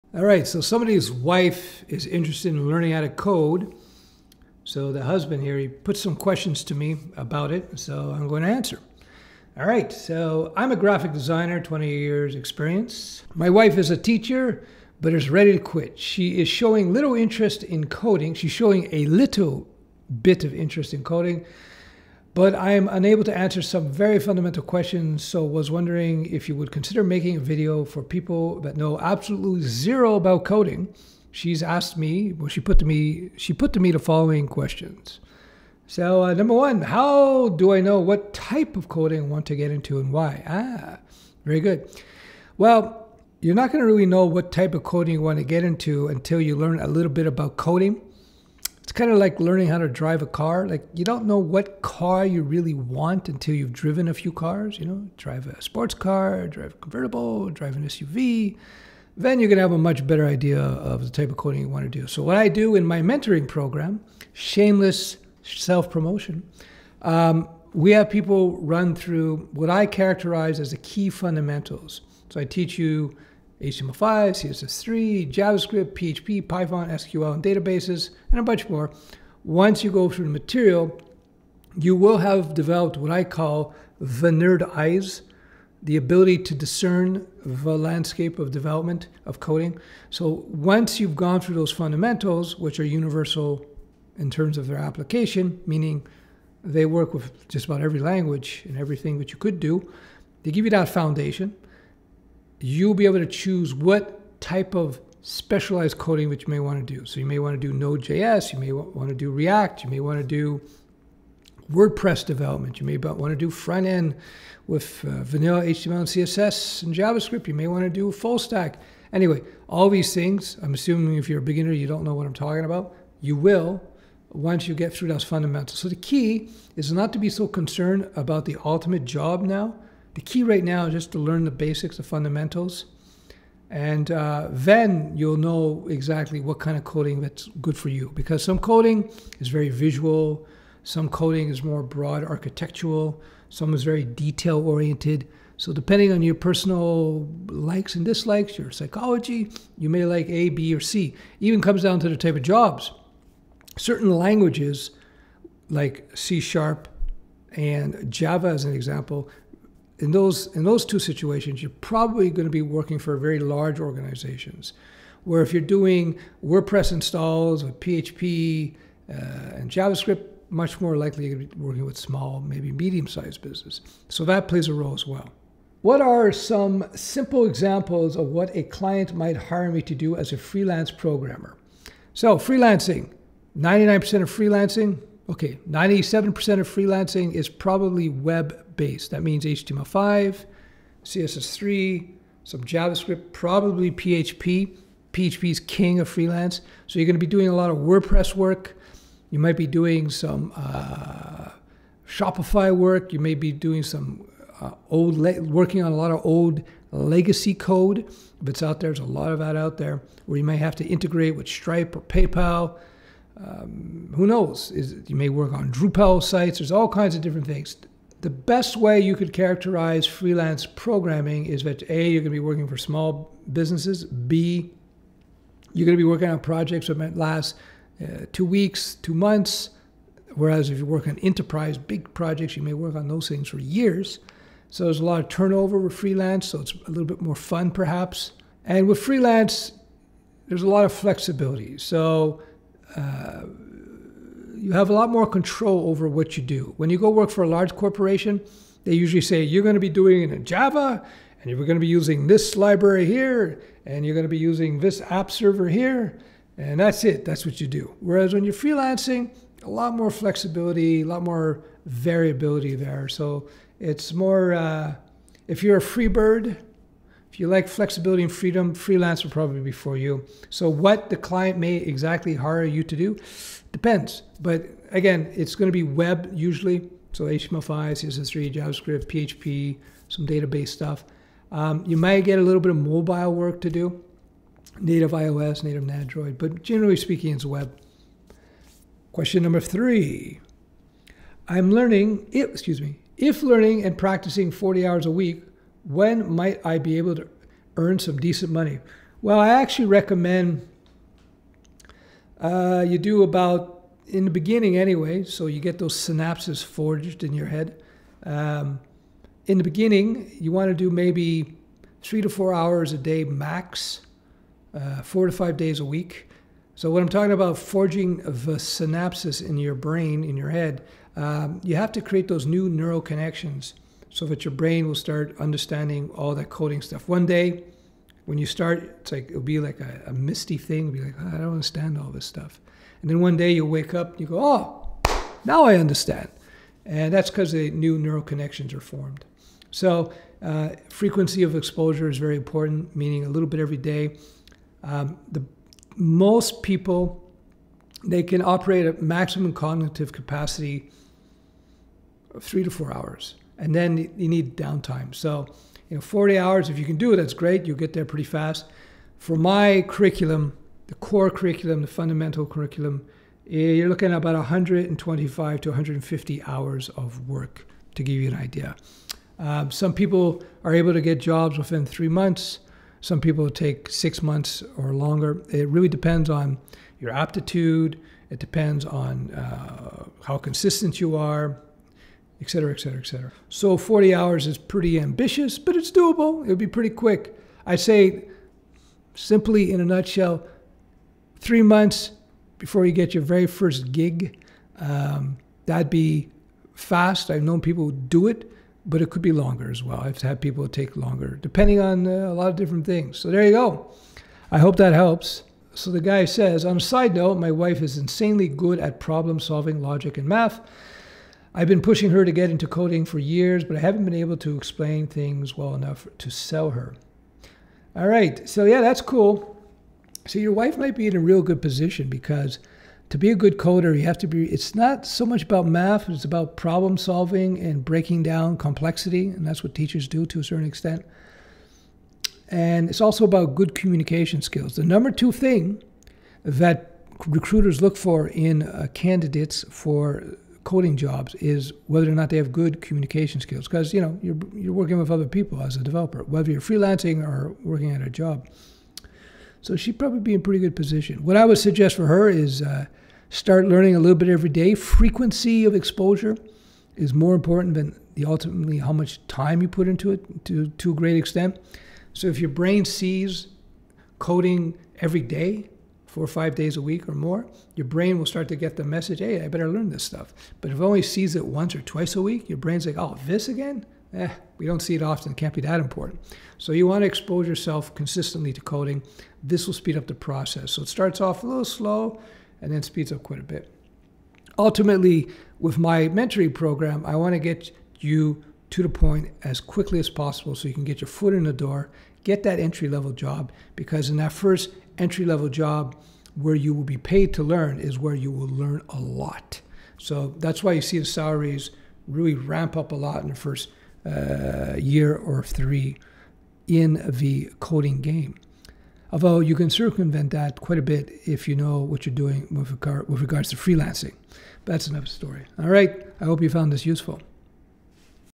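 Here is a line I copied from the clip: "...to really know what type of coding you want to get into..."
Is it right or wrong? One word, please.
right.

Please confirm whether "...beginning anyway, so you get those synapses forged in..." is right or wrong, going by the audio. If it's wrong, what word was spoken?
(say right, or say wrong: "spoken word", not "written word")
right.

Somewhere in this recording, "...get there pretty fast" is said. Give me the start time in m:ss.
5:57.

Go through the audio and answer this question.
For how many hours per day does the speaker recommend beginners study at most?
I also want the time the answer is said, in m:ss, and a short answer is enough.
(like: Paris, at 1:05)
3 to 4 hours, at 5:12.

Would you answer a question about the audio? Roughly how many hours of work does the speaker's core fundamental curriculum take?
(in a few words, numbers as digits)
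125 to 150 hours.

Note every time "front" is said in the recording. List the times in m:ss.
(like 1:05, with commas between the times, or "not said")
1:53.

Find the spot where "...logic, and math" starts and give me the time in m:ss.
6:49.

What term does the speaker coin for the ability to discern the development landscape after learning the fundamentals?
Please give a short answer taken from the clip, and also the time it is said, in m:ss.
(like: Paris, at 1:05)
Nerd eyes, at 1:23.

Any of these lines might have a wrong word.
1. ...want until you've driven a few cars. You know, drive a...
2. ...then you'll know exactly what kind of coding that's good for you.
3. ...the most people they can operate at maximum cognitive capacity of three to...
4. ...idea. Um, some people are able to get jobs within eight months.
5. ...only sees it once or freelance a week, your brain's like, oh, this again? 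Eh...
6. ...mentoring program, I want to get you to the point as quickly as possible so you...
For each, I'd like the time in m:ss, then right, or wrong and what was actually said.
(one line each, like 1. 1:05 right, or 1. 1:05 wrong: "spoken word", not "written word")
1. 0:52 right
2. 2:14 right
3. 5:45 right
4. 6:08 wrong: "three", not "eight"
5. 7:50 wrong: "twice", not "freelance"
6. 8:06 right.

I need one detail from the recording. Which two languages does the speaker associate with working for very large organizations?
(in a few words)
C sharp and Java.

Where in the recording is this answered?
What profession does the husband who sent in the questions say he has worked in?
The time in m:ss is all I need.
0:10.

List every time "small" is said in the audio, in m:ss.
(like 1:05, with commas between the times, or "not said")
2:51, 3:42.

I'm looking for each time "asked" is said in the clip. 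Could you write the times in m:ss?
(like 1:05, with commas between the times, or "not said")
0:31.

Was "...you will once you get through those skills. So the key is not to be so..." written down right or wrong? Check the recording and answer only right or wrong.
wrong.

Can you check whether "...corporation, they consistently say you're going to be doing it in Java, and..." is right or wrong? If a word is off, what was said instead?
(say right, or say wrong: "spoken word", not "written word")
wrong: "usually", not "consistently".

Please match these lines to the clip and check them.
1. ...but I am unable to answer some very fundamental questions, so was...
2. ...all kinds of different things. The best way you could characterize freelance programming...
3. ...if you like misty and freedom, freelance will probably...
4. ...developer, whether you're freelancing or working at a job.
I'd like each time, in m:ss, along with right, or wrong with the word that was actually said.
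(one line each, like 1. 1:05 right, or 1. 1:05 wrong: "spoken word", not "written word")
1. 0:22 right
2. 3:36 right
3. 4:27 wrong: "flexibility", not "misty"
4. 7:25 right.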